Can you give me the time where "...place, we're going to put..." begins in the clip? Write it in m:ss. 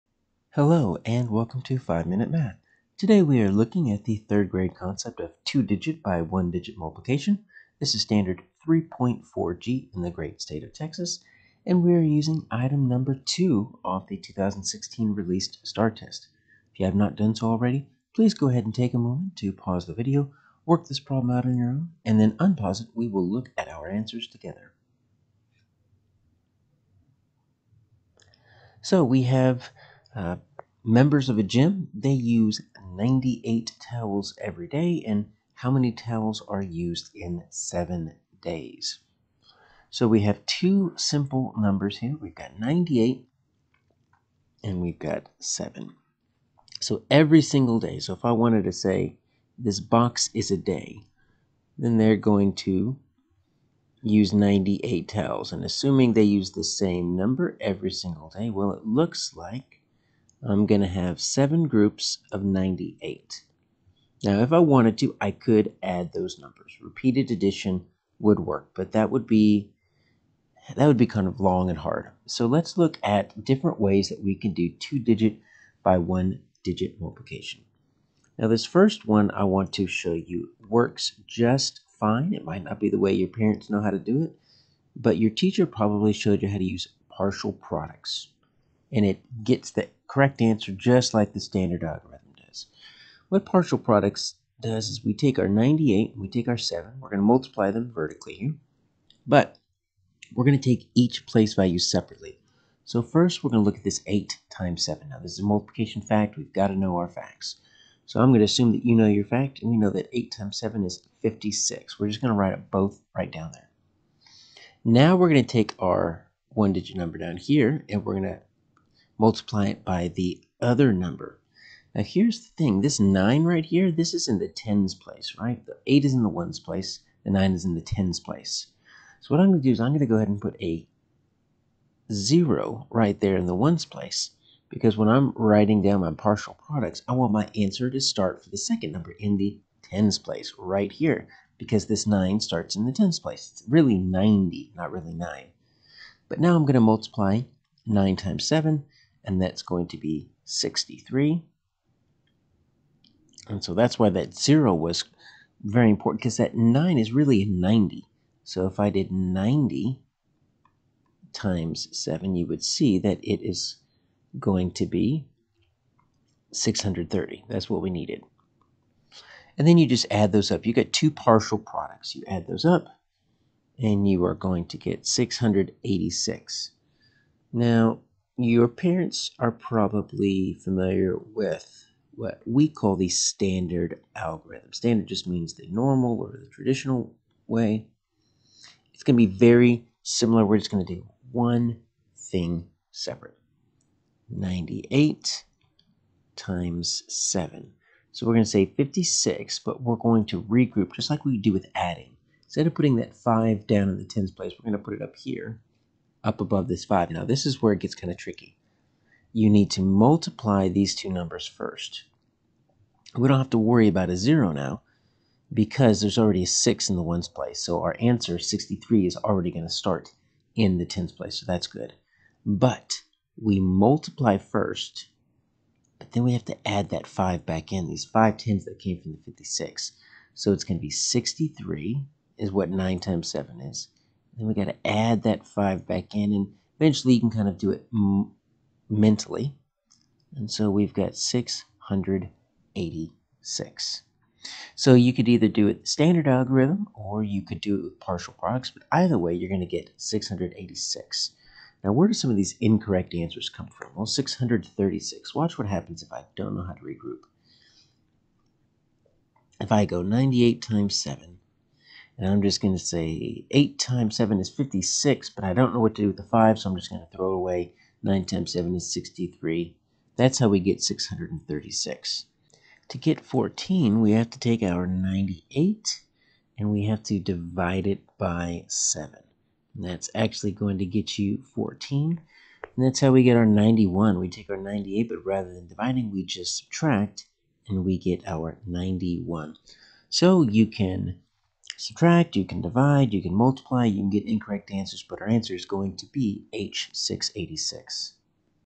3:24.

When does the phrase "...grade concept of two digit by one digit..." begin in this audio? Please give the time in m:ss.
0:04.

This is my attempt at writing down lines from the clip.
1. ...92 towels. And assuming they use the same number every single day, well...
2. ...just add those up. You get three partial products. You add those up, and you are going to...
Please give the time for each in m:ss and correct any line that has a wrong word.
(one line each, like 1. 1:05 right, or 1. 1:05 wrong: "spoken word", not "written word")
1. 0:54 wrong: "98", not "92"
2. 2:49 wrong: "two", not "three".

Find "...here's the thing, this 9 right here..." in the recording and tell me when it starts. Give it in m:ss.
2:02.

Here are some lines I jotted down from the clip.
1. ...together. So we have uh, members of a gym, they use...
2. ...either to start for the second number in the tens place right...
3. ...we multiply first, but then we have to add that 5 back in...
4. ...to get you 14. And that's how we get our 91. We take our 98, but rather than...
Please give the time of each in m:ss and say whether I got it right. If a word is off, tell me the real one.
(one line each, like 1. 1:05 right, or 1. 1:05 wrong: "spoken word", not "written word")
1. 0:24 right
2. 2:17 wrong: "answer", not "either"
3. 3:43 right
4. 4:40 right.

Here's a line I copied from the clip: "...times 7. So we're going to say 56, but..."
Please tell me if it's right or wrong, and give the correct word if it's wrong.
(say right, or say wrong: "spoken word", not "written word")
right.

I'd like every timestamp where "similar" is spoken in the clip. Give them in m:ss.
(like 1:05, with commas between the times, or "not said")
3:10.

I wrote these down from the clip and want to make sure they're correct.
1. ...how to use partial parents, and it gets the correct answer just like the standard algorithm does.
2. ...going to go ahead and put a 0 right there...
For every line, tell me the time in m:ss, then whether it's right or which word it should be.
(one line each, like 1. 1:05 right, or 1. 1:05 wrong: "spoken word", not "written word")
1. 1:26 wrong: "products", not "parents"
2. 2:09 right.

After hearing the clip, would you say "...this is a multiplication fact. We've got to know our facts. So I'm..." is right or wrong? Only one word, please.
right.